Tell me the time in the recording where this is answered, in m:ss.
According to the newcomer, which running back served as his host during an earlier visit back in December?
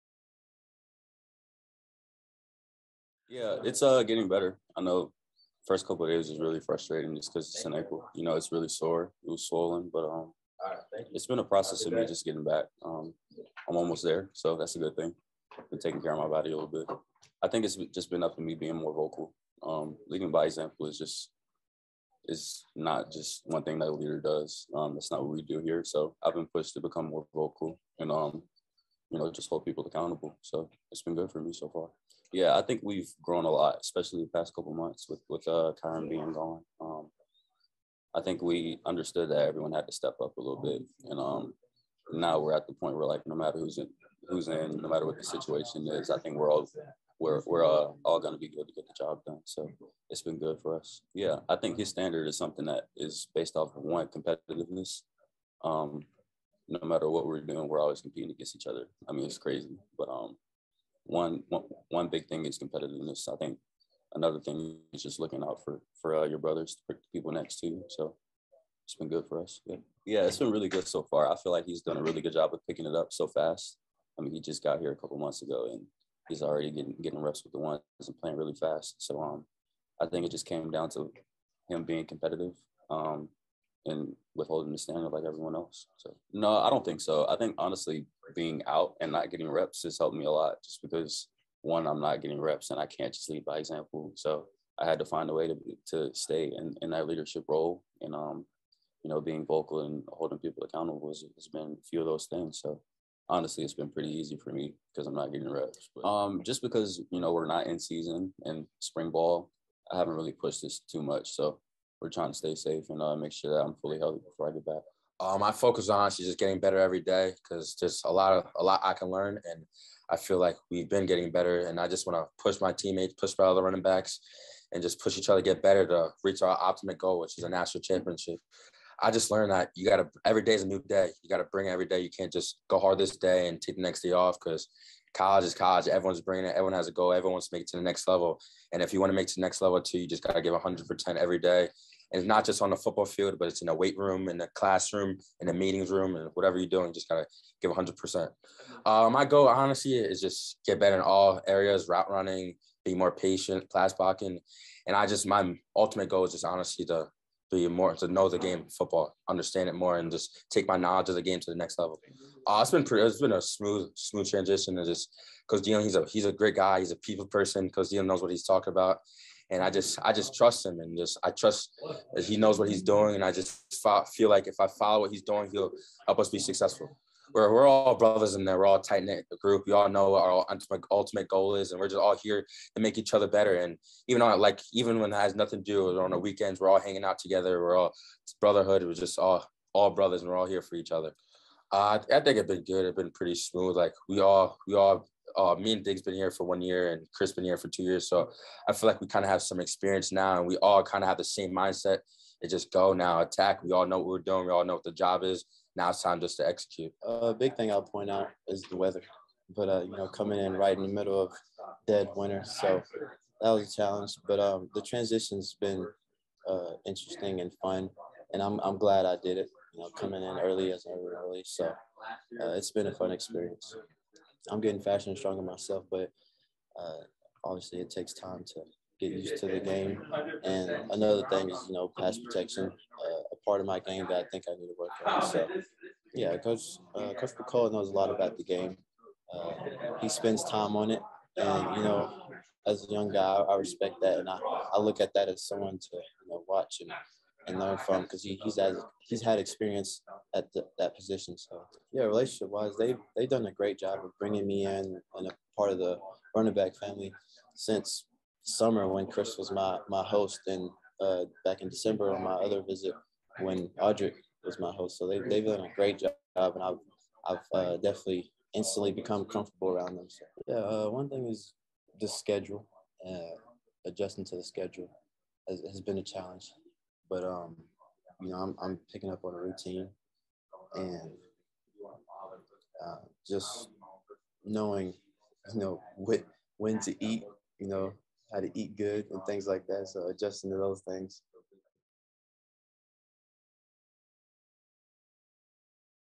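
4:23.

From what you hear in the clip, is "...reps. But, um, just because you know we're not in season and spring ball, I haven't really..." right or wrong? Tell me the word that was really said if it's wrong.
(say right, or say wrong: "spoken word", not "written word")
right.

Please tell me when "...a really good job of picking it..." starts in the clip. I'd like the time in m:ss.
1:11.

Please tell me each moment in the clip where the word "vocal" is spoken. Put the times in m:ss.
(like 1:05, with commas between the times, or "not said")
0:18, 0:27, 1:39.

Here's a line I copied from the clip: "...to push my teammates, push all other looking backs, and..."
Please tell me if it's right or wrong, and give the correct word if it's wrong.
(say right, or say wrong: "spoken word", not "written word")
wrong: "running", not "looking".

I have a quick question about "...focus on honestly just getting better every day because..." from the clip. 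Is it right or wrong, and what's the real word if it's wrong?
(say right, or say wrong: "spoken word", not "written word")
right.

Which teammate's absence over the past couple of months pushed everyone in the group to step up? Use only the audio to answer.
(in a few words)
Kyren.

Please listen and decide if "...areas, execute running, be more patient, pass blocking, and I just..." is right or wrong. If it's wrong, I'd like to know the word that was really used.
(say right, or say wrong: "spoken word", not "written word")
wrong: "route", not "execute".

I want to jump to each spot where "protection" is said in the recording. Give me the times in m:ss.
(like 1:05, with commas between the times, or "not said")
3:52.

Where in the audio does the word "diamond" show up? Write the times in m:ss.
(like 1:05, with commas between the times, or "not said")
not said.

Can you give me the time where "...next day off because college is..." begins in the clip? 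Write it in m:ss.
2:13.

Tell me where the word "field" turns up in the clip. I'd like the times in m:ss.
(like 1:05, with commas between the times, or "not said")
2:23.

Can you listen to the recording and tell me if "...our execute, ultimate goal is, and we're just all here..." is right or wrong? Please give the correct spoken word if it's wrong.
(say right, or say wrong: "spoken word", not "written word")
wrong: "ultimate", not "execute".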